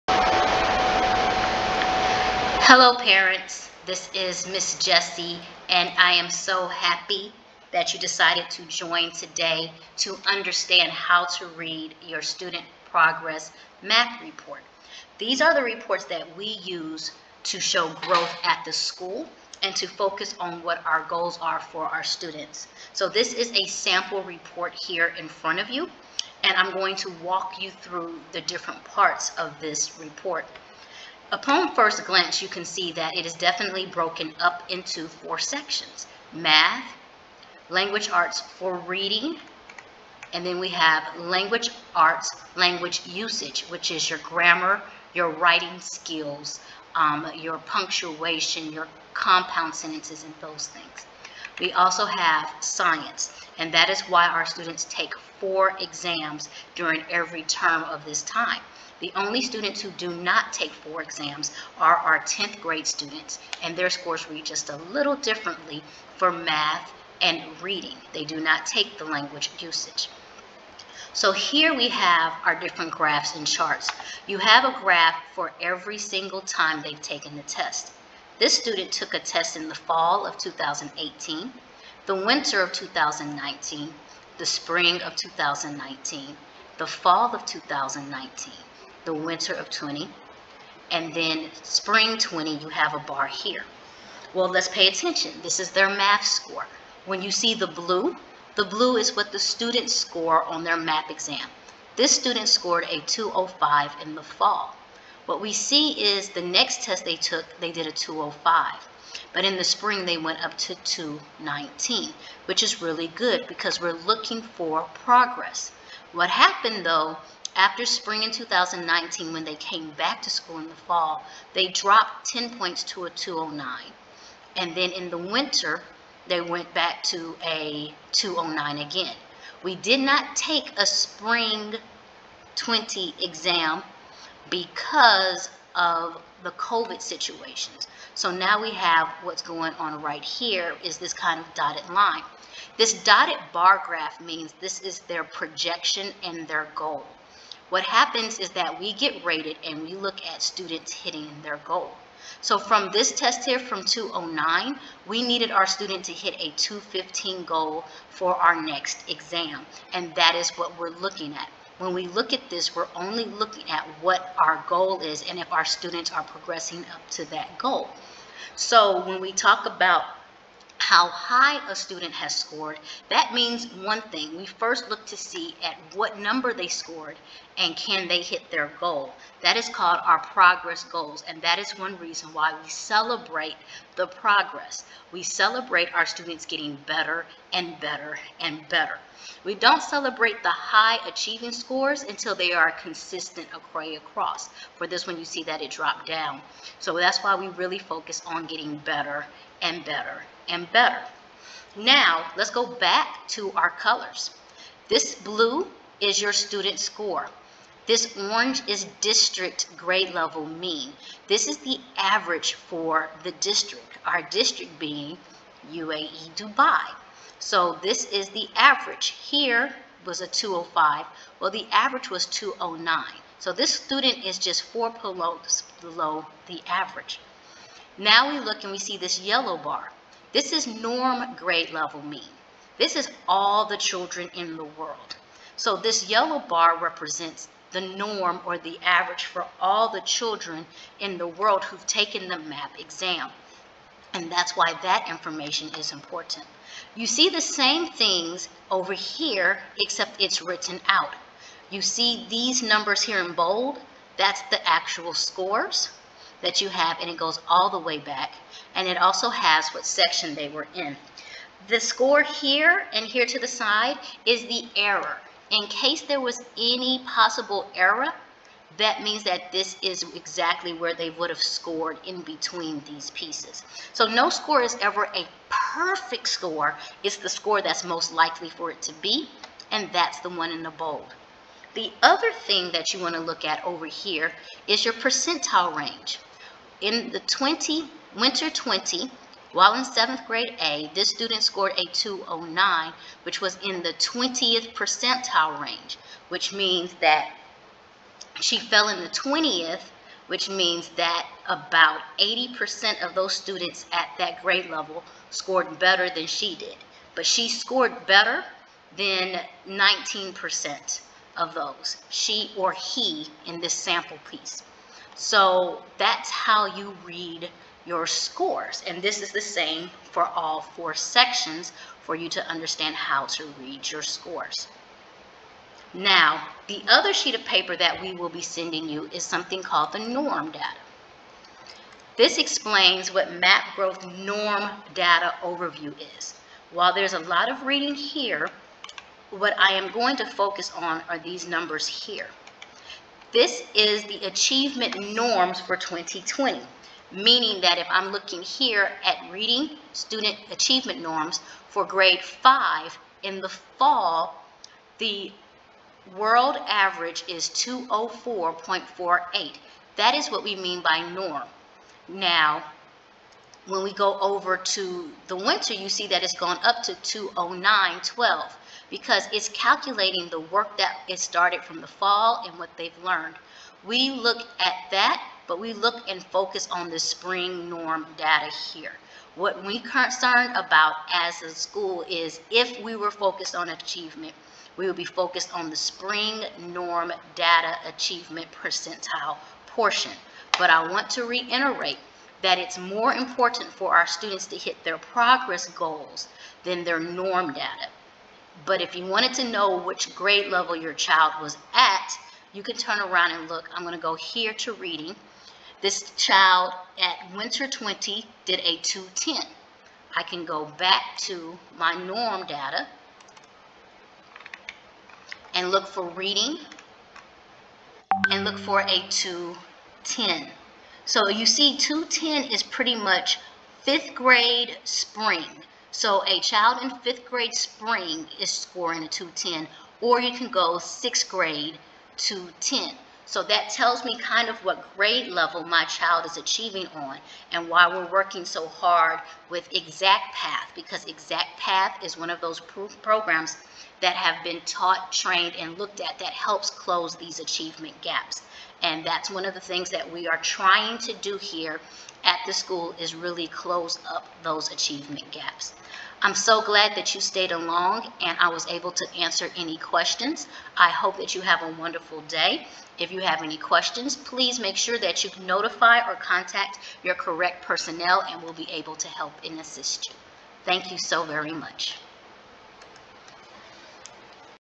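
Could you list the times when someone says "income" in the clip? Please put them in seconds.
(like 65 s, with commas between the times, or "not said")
not said.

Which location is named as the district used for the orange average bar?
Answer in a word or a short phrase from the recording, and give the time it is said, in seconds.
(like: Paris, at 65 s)
UAE Dubai, at 215 s.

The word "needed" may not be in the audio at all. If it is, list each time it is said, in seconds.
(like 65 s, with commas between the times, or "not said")
155 s.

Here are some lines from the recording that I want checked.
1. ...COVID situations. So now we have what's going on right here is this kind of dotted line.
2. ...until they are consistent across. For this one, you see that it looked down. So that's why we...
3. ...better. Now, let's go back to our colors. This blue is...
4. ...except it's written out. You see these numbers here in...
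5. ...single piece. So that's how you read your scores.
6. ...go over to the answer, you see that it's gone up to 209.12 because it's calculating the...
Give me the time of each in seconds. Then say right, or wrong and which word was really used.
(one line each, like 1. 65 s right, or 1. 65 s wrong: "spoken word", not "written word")
1. 136 s right
2. 192 s wrong: "dropped", not "looked"
3. 200 s right
4. 249 s right
5. 313 s wrong: "sample", not "single"
6. 363 s wrong: "winter", not "answer".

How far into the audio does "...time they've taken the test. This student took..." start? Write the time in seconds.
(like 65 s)
76 s.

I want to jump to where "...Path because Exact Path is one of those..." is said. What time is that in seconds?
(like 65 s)
440 s.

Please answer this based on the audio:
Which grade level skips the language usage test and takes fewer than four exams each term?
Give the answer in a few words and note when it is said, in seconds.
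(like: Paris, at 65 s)
10th grade, at 62 s.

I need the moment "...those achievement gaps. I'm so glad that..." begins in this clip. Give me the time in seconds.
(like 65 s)
454 s.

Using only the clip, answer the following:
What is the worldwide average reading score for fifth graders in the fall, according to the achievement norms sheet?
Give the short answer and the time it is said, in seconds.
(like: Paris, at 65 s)
204.48, at 357 s.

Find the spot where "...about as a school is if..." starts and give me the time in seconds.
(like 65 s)
380 s.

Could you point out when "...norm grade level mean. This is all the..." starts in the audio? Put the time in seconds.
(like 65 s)
230 s.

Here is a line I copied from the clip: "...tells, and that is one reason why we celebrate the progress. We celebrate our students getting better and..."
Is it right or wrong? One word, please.
wrong.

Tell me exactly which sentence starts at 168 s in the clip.
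So when we talk about how high a student has scored, that means one thing.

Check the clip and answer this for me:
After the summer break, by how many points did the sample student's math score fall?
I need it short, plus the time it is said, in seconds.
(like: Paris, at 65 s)
10 points, at 122 s.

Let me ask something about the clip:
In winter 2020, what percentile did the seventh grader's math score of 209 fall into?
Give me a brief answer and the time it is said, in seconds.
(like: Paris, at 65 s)
20th percentile, at 293 s.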